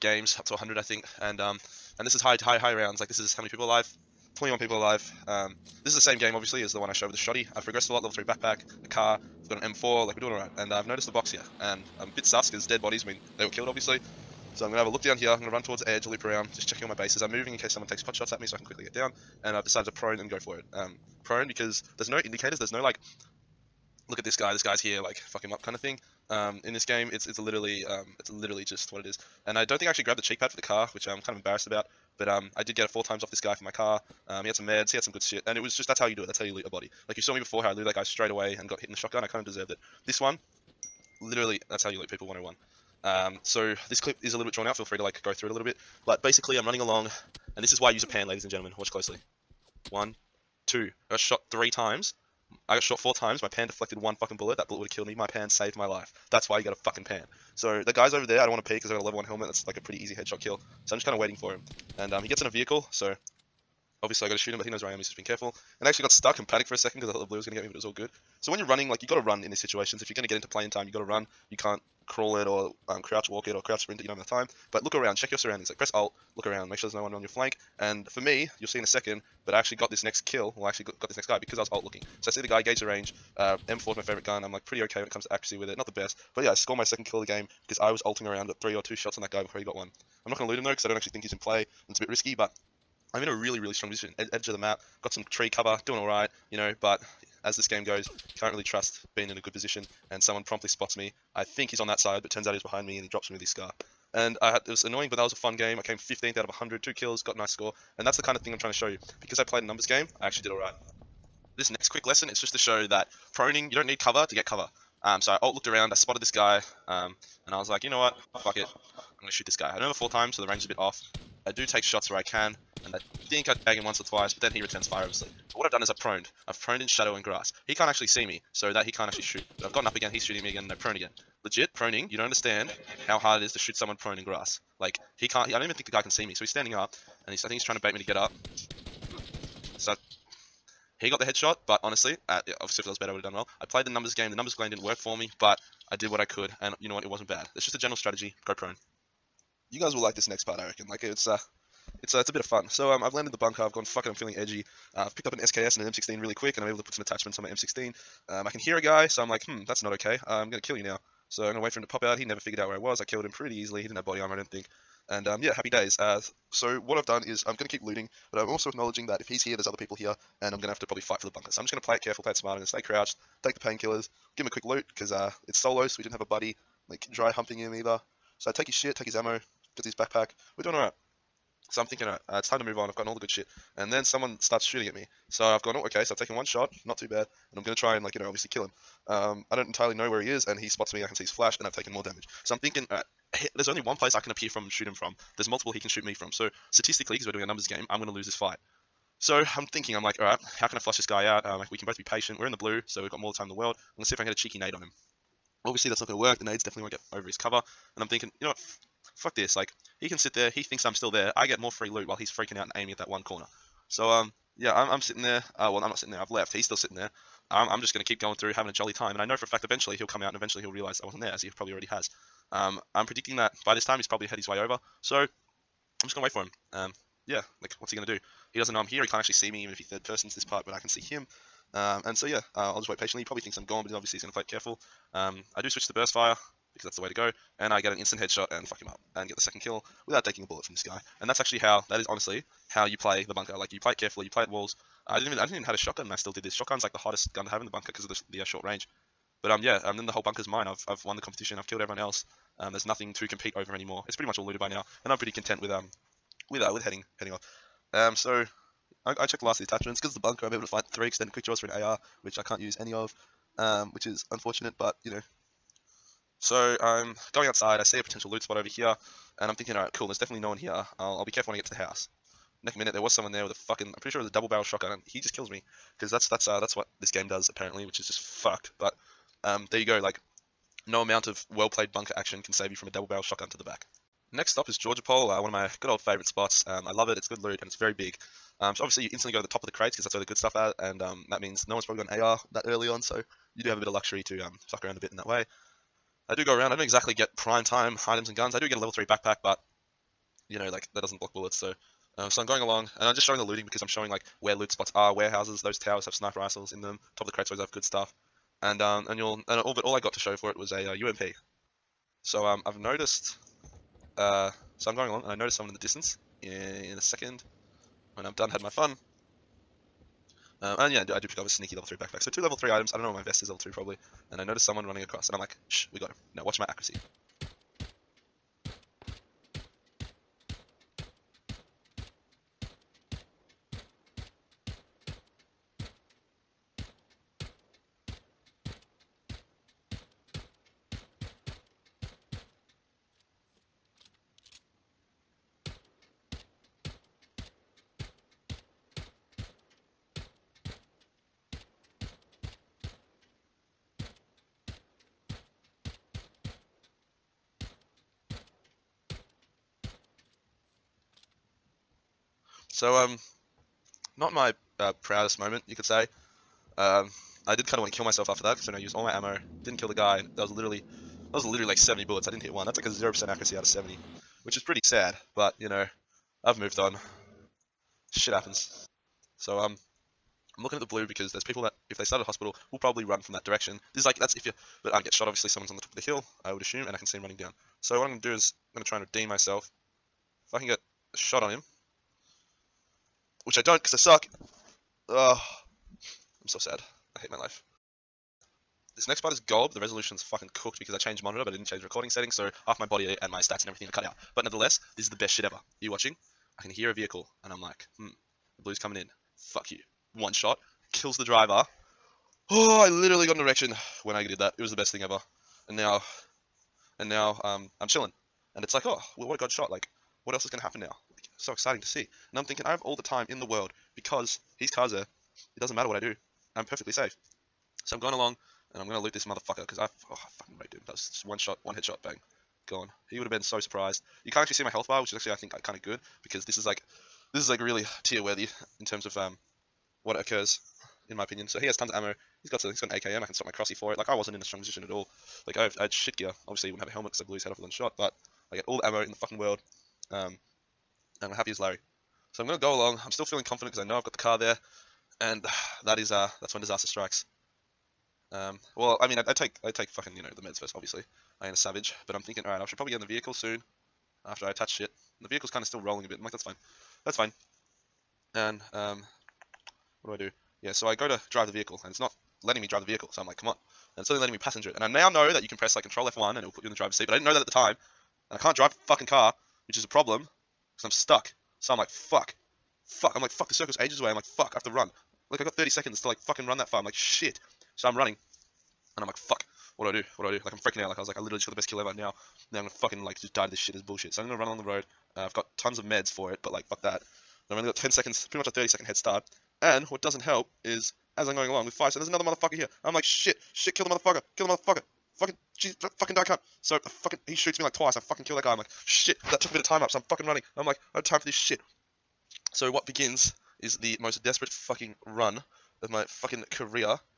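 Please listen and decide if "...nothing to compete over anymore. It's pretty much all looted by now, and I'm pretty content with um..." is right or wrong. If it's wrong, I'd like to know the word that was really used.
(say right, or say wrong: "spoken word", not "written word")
right.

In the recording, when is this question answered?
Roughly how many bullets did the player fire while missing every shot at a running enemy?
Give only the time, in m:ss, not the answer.
6:11.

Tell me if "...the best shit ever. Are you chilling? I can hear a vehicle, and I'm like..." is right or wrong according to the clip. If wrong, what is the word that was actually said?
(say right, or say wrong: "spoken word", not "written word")
wrong: "watching", not "chilling".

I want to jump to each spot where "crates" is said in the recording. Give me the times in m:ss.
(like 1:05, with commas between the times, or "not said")
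4:49, 5:07.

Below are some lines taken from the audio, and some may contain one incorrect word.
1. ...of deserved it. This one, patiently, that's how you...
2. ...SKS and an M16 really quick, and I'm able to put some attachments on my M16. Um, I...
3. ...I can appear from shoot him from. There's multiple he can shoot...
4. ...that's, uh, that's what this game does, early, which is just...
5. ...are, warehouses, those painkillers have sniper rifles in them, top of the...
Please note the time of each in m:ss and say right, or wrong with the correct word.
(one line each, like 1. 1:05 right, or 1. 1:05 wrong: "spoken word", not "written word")
1. 0:39 wrong: "literally", not "patiently"
2. 2:35 right
3. 3:14 right
4. 4:36 wrong: "apparently", not "early"
5. 5:04 wrong: "towers", not "painkillers".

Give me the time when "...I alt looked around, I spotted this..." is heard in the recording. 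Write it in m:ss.
1:55.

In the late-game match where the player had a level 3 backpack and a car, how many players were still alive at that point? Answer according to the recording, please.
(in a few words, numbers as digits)
21.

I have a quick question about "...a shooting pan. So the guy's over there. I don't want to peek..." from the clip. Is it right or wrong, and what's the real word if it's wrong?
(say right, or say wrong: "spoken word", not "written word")
wrong: "fucking", not "shooting".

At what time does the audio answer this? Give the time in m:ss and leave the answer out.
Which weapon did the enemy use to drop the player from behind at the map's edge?
1:43.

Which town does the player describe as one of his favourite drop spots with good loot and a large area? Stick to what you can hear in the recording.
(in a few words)
Georgopol.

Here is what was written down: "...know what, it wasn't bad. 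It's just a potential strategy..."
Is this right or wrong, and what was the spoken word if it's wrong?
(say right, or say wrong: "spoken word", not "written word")
wrong: "general", not "potential".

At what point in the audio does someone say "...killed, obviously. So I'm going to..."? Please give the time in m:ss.
0:13.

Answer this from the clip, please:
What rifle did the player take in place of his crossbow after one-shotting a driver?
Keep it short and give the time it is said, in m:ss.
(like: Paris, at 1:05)
AKM, at 7:22.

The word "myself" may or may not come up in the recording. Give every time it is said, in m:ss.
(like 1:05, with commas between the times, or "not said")
6:08, 6:29.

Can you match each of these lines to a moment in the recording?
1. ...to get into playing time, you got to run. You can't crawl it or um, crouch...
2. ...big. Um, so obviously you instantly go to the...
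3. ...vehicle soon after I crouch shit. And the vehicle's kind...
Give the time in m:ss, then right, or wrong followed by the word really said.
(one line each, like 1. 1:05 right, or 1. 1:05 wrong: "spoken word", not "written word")
1. 1:10 right
2. 4:47 right
3. 7:43 wrong: "attach", not "crouch".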